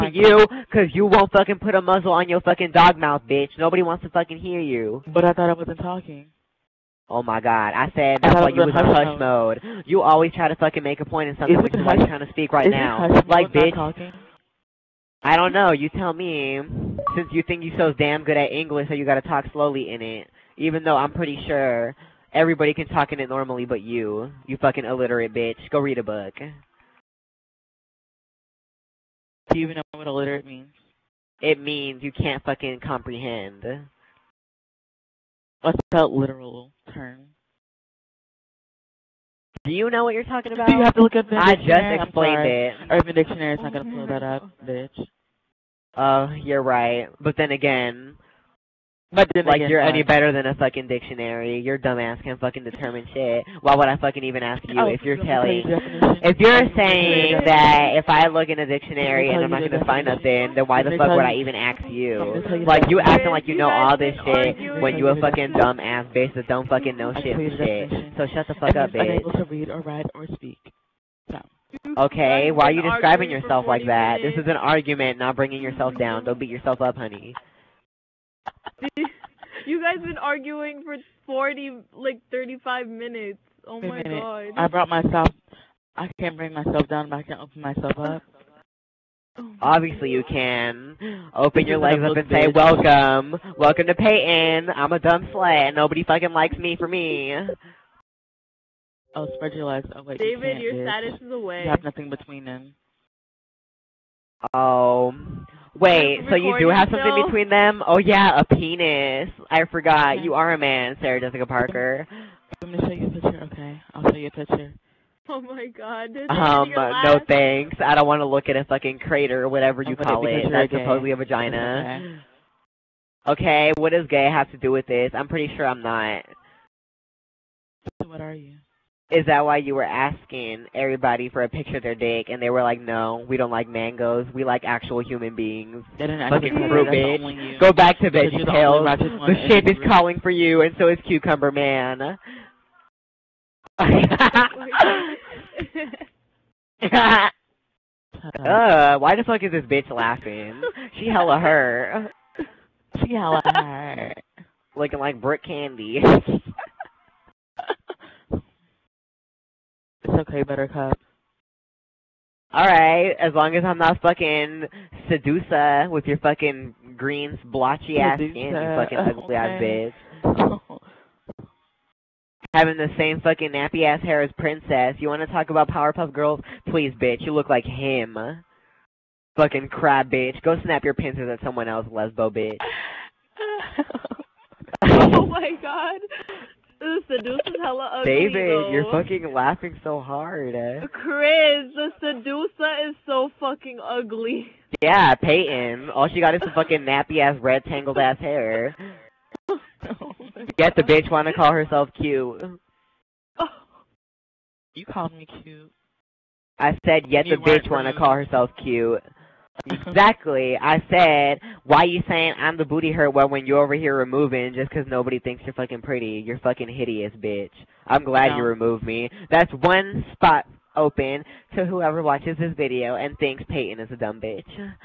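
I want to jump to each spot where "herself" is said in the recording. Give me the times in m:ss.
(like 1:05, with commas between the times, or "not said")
3:21, 3:28.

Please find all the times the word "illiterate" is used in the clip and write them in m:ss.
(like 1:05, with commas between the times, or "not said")
0:24, 0:30.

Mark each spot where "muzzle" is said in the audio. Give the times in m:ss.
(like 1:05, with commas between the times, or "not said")
0:01.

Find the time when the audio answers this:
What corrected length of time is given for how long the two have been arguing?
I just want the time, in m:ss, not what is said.
1:22.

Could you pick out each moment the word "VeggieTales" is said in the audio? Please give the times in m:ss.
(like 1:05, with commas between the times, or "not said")
2:18.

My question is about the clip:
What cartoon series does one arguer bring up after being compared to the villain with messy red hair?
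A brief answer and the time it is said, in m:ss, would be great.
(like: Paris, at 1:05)
Powerpuff Girls, at 2:55.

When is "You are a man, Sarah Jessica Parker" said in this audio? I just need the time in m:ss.
1:50.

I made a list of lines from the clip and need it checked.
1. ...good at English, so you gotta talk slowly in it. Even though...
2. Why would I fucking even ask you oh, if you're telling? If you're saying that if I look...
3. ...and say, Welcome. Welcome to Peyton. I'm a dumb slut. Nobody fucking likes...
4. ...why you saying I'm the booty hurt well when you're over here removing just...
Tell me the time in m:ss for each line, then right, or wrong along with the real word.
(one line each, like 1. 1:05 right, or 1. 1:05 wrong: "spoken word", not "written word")
1. 0:18 right
2. 0:53 right
3. 1:32 right
4. 3:31 right.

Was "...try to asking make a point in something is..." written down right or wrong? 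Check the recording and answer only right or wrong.
wrong.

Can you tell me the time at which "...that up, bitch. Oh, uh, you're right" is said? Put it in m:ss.
0:44.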